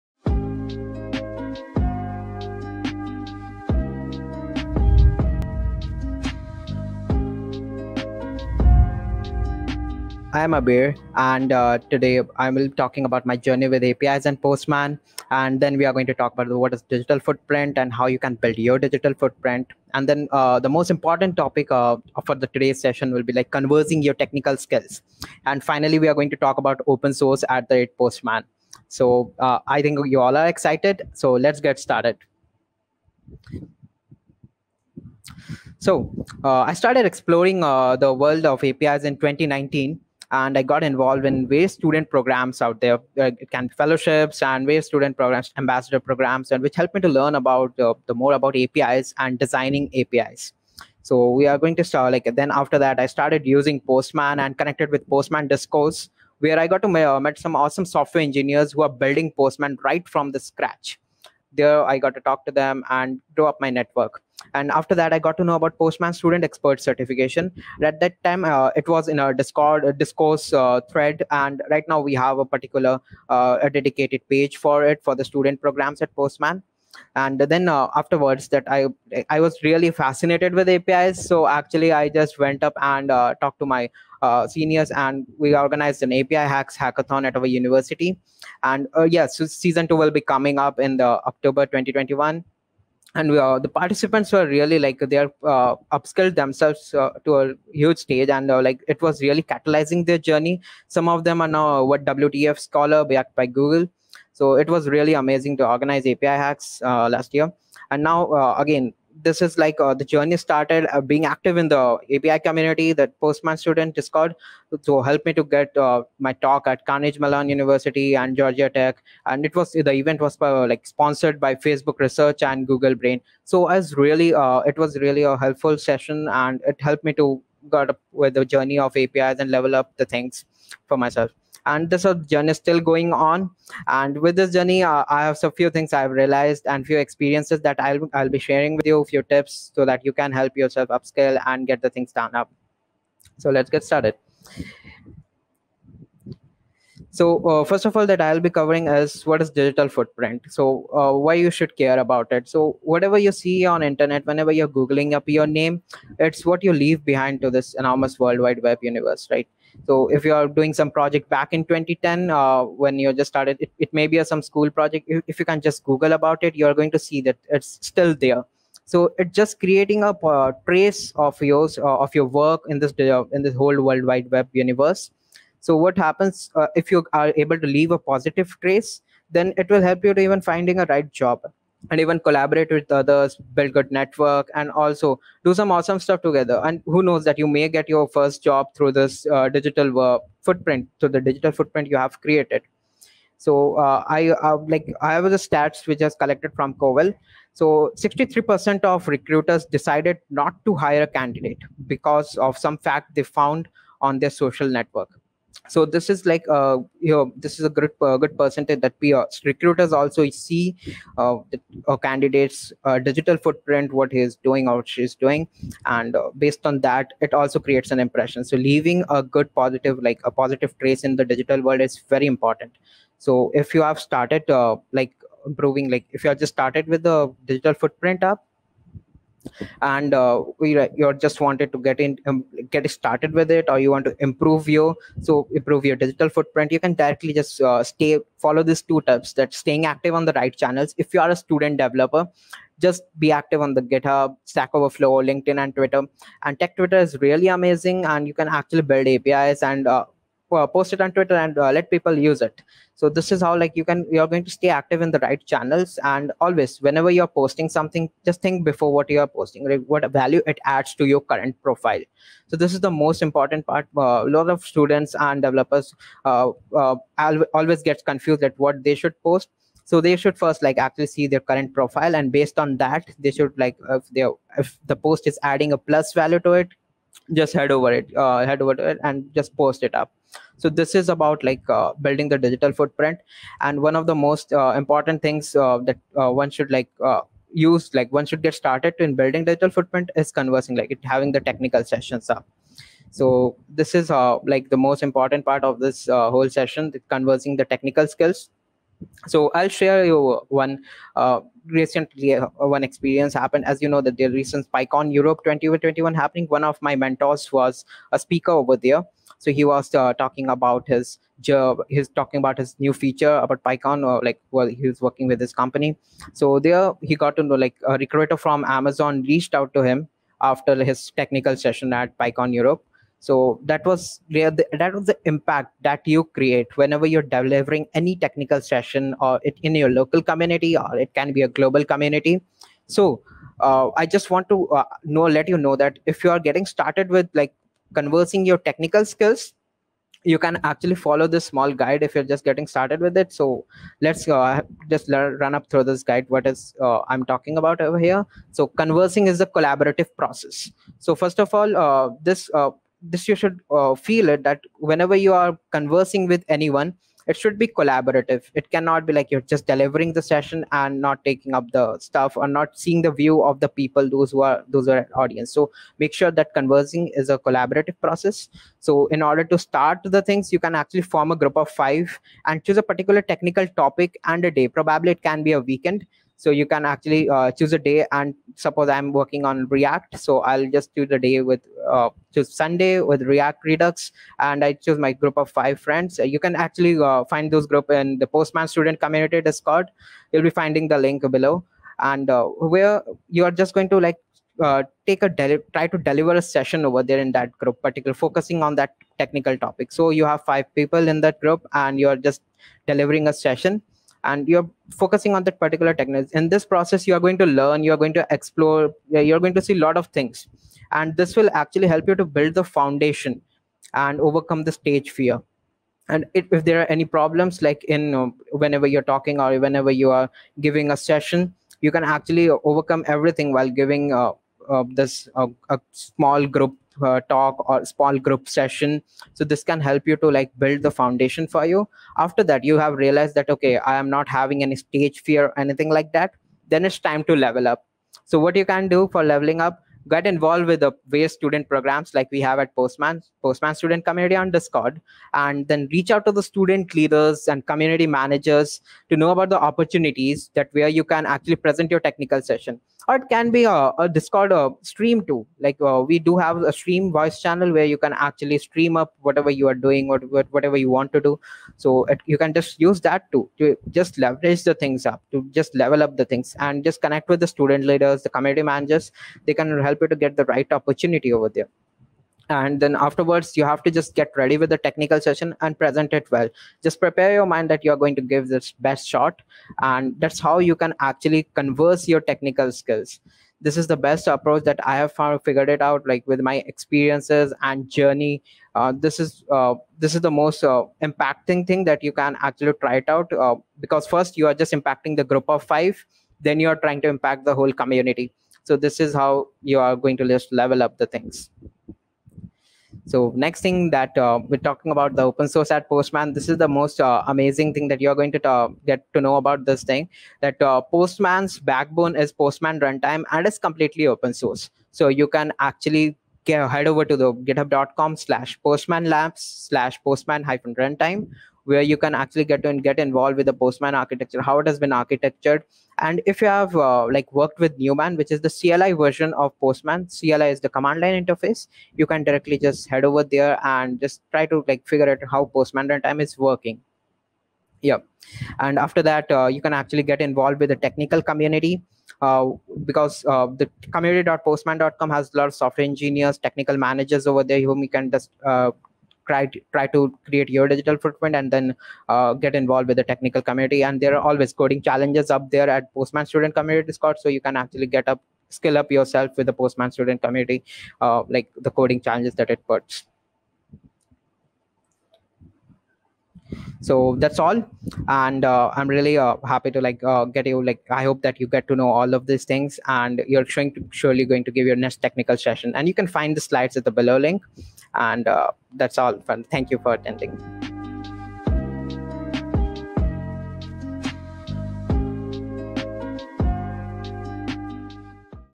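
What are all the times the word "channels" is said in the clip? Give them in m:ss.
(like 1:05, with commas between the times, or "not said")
4:00, 4:15, 7:37.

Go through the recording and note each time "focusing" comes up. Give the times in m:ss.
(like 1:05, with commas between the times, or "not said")
6:38, 6:44.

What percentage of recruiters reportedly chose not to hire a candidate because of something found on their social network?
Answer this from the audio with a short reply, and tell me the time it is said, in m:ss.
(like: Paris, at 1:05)
63%, at 3:17.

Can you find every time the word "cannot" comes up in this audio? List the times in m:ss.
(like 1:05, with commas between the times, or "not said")
5:58.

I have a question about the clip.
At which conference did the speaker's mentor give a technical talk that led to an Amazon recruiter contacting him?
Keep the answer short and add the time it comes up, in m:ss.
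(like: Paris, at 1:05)
PyCon Europe 2021, at 5:04.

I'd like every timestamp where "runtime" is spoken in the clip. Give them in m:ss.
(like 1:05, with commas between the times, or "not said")
8:32, 8:40, 8:55.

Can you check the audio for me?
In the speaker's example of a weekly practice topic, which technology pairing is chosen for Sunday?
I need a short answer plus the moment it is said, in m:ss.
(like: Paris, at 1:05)
React Redux, at 6:23.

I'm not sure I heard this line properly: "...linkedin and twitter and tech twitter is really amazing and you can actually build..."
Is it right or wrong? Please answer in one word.
right.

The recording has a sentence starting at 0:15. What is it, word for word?
And then we are going to talk about what is digital footprint and how you can build your digital footprint.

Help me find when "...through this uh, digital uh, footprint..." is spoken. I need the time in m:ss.
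3:08.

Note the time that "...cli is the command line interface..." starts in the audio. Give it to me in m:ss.
8:50.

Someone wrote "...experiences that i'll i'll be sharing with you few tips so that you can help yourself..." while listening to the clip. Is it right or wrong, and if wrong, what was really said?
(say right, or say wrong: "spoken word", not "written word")
right.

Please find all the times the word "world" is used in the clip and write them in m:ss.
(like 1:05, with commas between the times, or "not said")
0:38, 2:38, 2:53, 3:41.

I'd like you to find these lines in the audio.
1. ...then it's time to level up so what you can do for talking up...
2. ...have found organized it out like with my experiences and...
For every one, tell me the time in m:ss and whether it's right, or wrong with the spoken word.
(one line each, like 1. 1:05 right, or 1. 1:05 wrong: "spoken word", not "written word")
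1. 7:16 wrong: "leveling", not "talking"
2. 8:04 wrong: "figured", not "organized".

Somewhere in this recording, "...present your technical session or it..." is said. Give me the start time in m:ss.
7:31.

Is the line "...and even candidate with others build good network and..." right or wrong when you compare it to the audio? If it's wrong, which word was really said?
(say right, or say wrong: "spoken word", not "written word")
wrong: "collaborate", not "candidate".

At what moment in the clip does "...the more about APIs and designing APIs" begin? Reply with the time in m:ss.
0:48.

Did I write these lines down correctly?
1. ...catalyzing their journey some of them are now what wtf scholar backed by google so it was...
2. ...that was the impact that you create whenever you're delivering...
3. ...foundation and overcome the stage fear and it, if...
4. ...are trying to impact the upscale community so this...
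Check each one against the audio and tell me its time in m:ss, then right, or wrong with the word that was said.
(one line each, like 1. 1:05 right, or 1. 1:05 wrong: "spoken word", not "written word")
1. 1:39 right
2. 5:24 right
3. 6:52 right
4. 8:16 wrong: "whole", not "upscale".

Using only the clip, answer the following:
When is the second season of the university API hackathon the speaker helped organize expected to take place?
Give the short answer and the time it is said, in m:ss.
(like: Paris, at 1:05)
October 2021, at 1:31.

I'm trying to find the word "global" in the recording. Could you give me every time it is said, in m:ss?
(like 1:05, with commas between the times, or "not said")
5:31.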